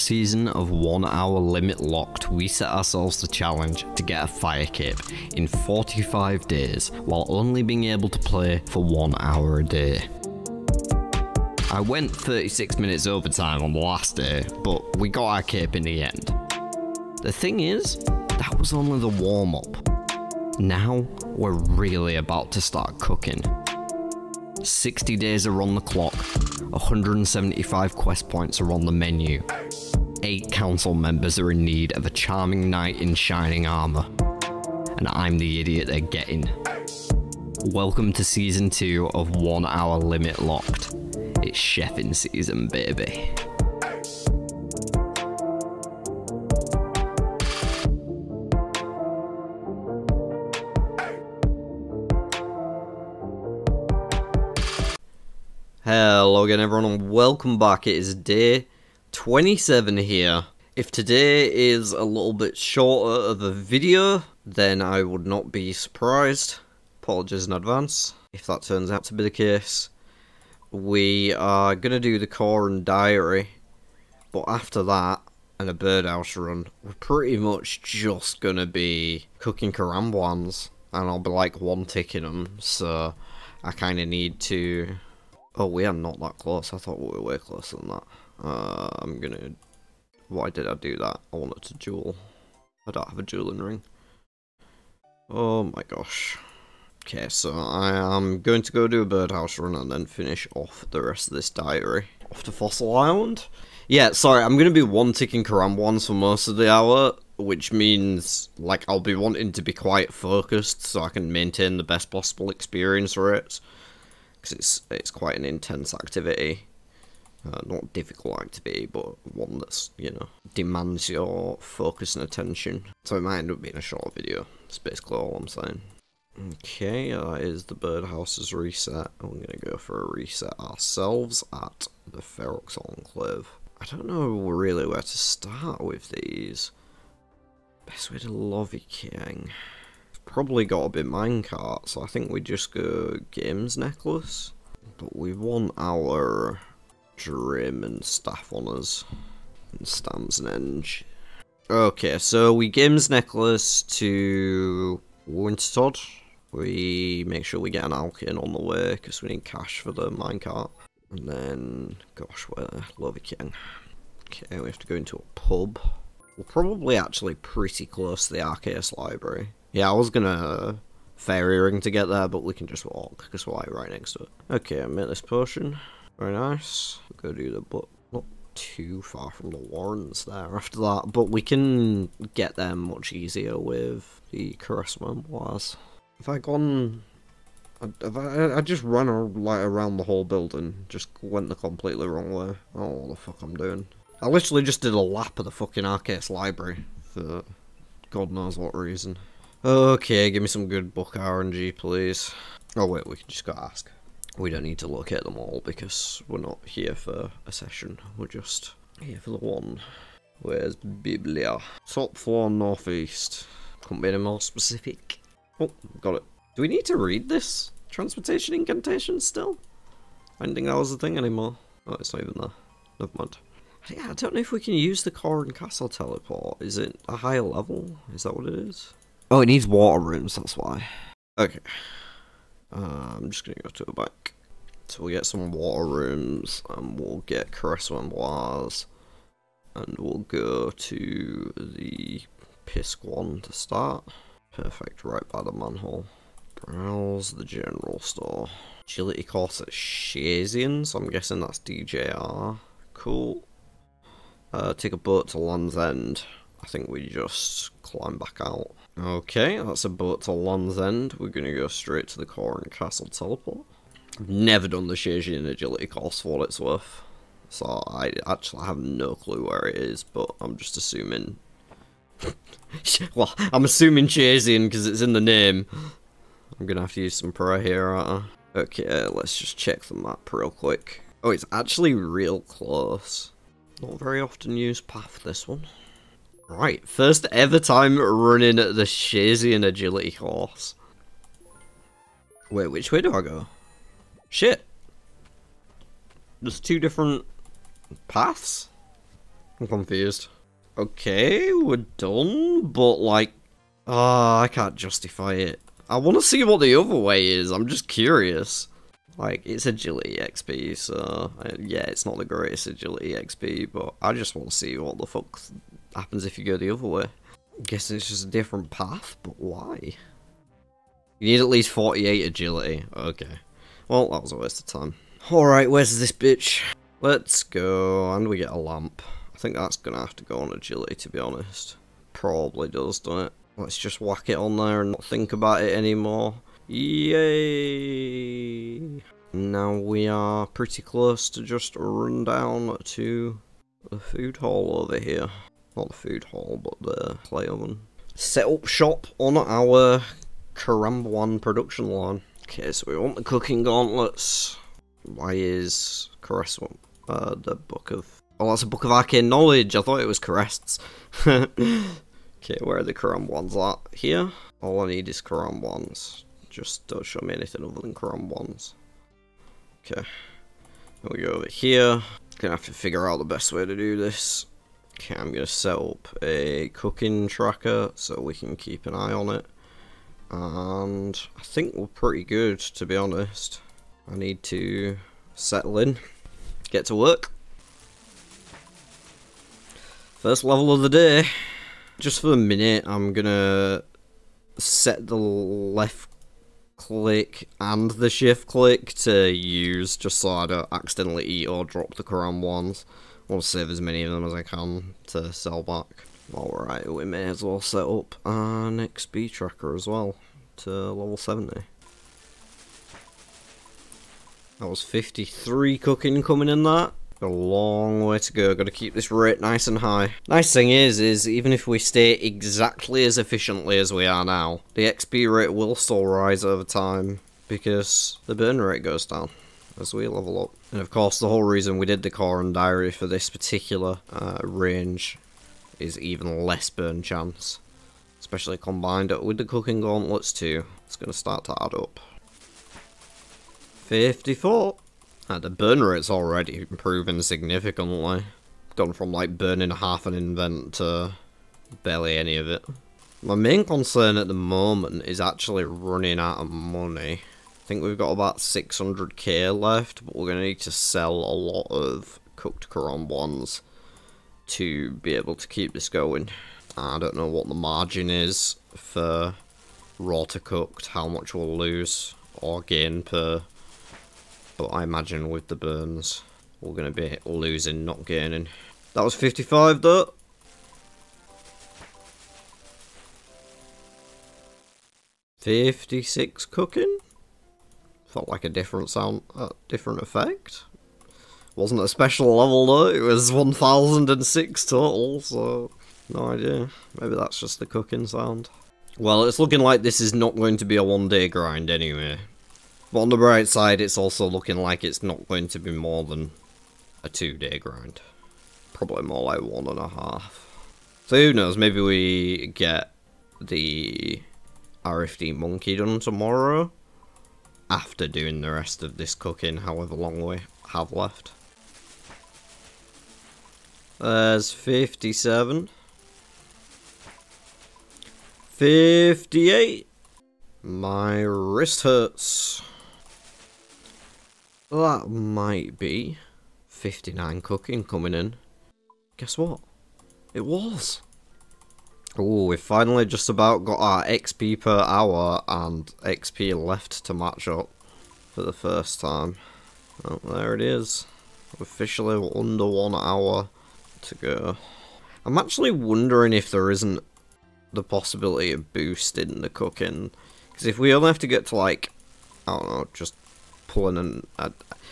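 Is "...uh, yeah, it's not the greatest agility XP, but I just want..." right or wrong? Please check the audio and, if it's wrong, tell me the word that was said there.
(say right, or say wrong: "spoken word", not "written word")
right.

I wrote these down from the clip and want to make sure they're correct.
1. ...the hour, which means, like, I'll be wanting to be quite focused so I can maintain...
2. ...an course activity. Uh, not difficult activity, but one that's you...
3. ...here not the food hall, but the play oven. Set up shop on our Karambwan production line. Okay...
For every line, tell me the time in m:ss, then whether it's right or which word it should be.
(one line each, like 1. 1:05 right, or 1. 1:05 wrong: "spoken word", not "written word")
1. 1:46 right
2. 1:55 wrong: "intense", not "course"
3. 5:44 right.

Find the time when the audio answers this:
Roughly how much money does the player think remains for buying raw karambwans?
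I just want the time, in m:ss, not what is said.
7:38.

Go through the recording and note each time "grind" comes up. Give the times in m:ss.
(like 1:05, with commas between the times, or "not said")
8:21, 8:27.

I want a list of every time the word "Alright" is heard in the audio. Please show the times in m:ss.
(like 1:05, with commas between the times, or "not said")
5:25, 6:46.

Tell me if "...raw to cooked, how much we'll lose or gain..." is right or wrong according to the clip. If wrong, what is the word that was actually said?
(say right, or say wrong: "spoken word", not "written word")
right.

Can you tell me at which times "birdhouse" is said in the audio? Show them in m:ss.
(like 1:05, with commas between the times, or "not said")
1:15, 1:39, 2:07.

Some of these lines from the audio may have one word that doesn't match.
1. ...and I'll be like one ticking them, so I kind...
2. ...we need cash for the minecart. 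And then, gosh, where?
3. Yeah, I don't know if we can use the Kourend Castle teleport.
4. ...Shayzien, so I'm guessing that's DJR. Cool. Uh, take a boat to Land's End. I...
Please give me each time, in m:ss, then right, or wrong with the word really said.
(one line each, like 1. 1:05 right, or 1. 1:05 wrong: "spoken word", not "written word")
1. 1:20 right
2. 2:39 right
3. 3:43 right
4. 4:09 right.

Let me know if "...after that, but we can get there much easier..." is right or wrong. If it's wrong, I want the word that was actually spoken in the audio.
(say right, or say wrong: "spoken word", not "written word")
right.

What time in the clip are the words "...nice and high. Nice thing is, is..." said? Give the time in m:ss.
6:59.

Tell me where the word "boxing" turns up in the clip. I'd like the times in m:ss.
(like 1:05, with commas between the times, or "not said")
not said.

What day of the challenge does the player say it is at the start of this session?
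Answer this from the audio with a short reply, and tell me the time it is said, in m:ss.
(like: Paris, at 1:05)
27, at 0:58.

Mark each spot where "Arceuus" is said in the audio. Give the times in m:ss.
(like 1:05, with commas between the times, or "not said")
2:48, 3:15.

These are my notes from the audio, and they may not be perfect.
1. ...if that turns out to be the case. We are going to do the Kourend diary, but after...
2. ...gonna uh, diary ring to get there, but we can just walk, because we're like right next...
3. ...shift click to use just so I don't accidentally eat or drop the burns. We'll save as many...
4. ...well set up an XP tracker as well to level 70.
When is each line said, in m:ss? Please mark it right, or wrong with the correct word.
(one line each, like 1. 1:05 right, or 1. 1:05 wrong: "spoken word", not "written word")
1. 1:08 right
2. 2:50 wrong: "fairy", not "diary"
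3. 6:38 wrong: "karambwans", not "burns"
4. 6:47 right.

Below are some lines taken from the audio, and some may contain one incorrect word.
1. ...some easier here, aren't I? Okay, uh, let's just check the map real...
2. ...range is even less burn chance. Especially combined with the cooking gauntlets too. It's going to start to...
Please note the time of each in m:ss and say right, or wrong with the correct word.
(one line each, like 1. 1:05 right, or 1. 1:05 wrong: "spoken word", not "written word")
1. 4:37 wrong: "prayer", not "easier"
2. 7:14 right.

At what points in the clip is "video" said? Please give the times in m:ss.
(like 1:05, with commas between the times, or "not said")
1:03, 2:04.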